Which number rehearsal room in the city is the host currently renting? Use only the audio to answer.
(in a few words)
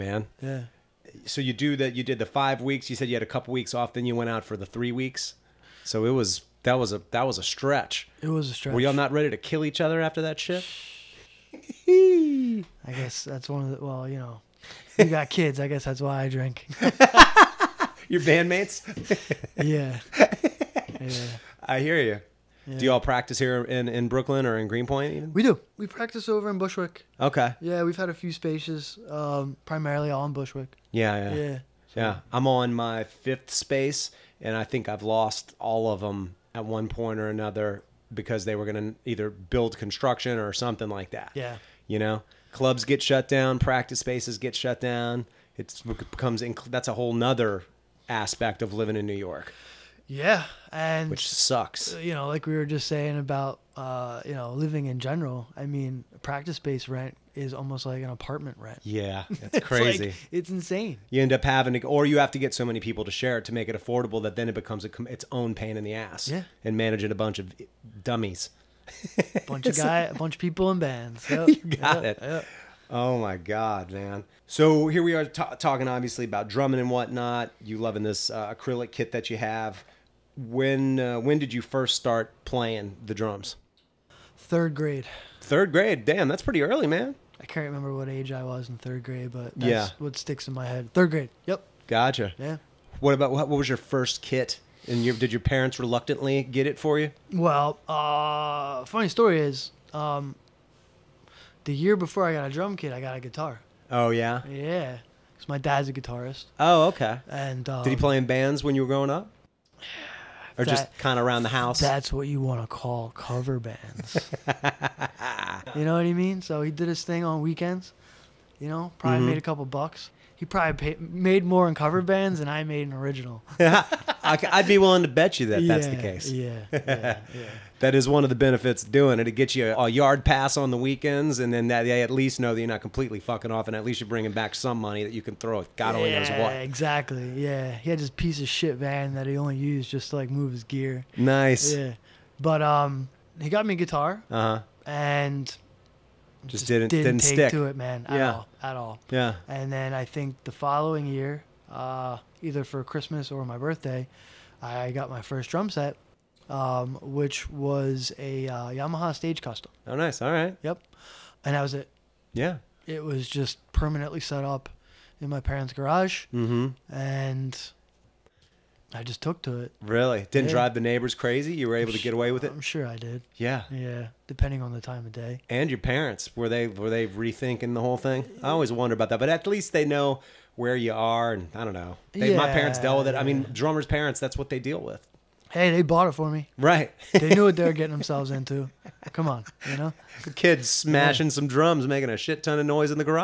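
5th.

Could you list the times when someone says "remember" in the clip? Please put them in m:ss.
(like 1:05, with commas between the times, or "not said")
1:27.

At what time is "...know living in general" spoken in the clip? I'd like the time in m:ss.
0:54.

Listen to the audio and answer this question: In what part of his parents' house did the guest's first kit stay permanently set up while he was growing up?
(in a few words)
Garage.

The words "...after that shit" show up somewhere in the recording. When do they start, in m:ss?
0:10.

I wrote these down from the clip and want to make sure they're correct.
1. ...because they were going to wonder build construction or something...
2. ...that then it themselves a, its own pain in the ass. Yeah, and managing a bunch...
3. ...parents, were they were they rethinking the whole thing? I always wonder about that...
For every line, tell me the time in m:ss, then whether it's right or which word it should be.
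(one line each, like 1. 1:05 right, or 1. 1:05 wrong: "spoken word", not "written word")
1. 0:38 wrong: "either", not "wonder"
2. 1:04 wrong: "becomes", not "themselves"
3. 2:55 right.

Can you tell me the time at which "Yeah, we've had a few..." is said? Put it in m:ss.
0:27.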